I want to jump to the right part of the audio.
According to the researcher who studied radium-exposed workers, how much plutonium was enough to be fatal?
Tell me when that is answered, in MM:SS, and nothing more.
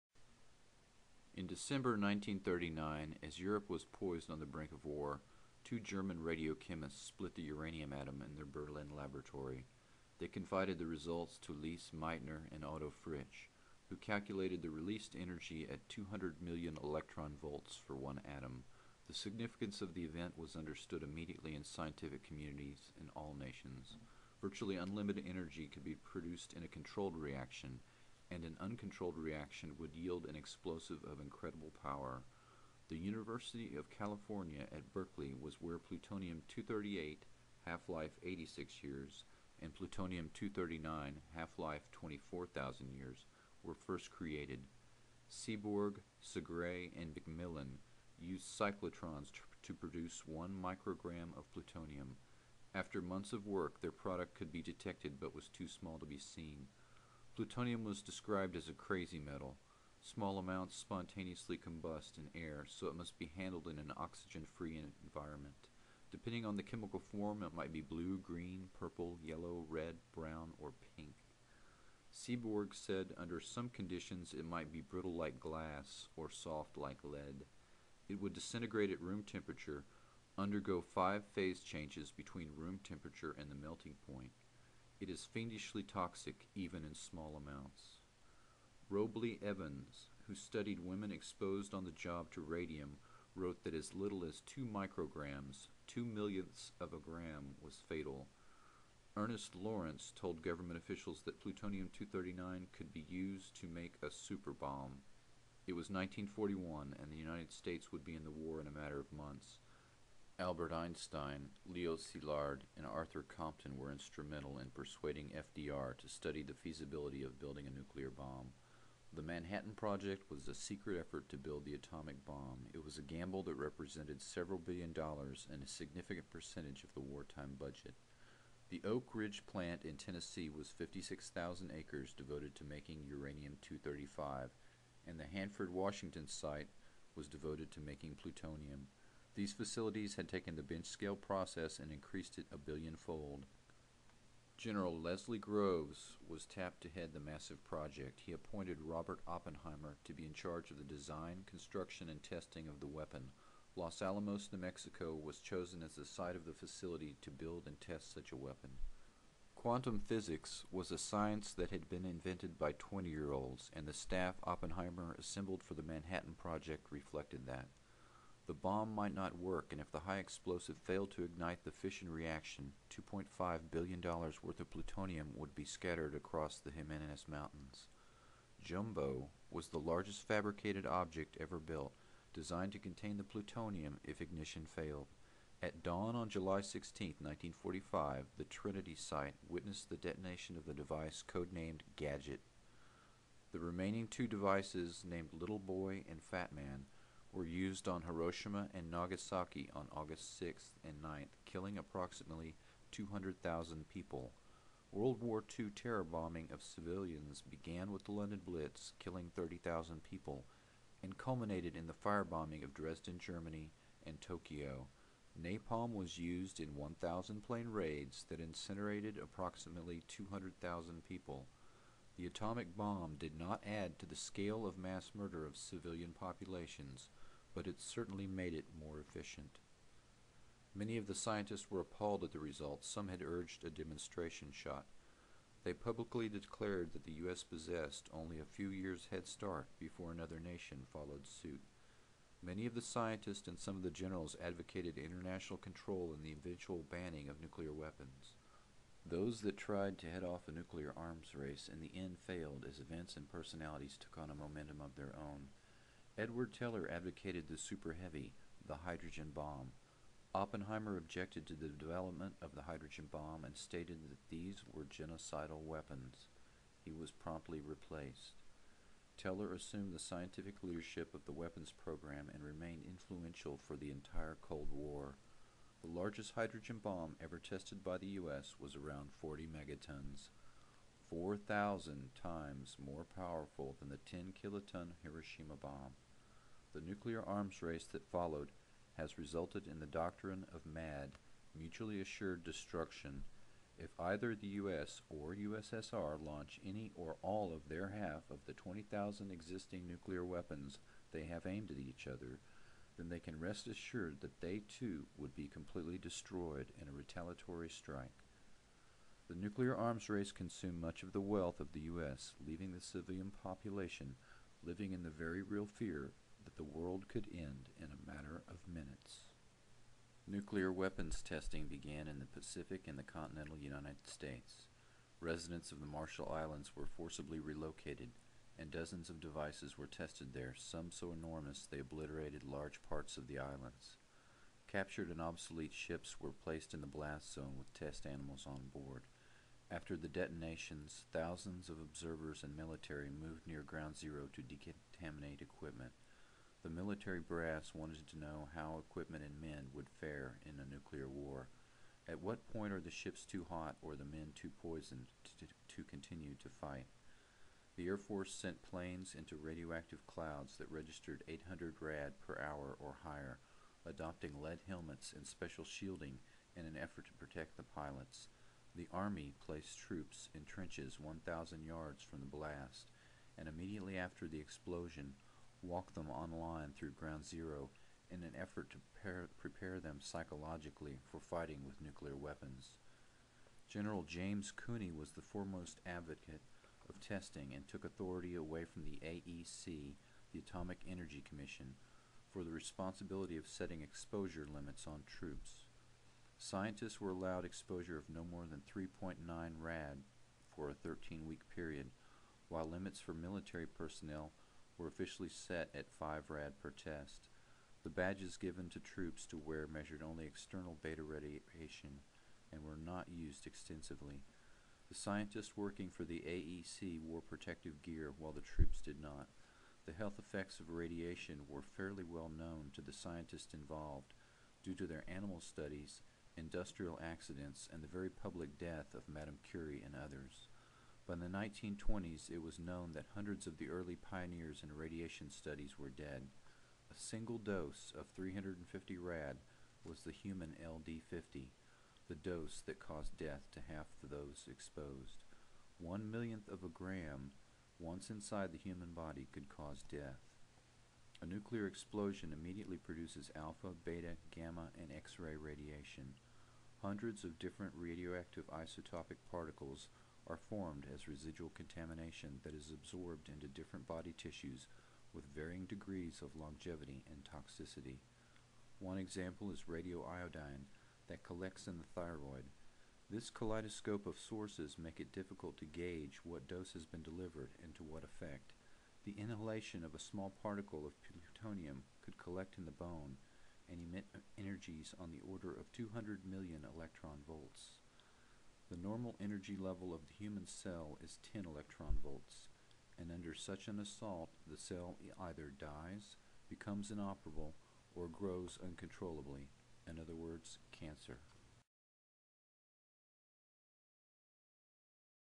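01:34.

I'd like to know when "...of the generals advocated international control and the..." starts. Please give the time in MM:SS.
04:03.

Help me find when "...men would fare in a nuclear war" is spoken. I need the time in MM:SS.
05:49.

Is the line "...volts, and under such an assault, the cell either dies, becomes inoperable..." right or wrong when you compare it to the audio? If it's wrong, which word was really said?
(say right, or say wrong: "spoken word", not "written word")
right.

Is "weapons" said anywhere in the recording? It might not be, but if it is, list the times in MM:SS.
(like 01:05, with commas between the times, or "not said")
02:32, 02:38, 04:07, 04:25, 04:31, 05:00, 05:20, 06:22.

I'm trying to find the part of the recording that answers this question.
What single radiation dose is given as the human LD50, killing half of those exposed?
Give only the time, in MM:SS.
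07:18.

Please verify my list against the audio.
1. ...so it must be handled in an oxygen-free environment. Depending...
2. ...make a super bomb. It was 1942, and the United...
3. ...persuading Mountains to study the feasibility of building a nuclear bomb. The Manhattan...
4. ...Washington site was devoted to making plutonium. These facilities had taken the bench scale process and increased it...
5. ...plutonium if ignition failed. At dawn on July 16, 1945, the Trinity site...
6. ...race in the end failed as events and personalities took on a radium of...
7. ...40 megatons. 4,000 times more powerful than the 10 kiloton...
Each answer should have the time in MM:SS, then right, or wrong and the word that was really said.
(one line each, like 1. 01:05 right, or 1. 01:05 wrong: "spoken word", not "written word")
1. 01:02 right
2. 01:43 wrong: "1941", not "1942"
3. 01:54 wrong: "FDR", not "Mountains"
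4. 02:15 right
5. 03:03 right
6. 04:11 wrong: "momentum", not "radium"
7. 04:39 right.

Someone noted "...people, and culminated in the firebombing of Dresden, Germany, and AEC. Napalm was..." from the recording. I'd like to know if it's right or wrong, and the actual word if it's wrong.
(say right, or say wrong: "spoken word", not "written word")
wrong: "Tokyo", not "AEC".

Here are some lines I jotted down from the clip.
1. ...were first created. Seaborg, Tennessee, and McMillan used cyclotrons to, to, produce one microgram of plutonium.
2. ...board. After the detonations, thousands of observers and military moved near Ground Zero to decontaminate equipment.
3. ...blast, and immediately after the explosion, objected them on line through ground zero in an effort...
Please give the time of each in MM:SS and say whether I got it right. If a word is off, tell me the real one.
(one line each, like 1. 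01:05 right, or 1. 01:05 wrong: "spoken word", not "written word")
1. 00:43 wrong: "Segre", not "Tennessee"
2. 05:38 right
3. 06:12 wrong: "walked", not "objected".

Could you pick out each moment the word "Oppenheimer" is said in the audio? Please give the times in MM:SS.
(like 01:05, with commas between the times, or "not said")
02:29, 02:44, 04:20.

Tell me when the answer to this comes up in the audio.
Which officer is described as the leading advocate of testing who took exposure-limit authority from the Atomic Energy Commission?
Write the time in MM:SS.
06:24.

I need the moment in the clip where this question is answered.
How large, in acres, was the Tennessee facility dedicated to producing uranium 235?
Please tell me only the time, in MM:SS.
02:10.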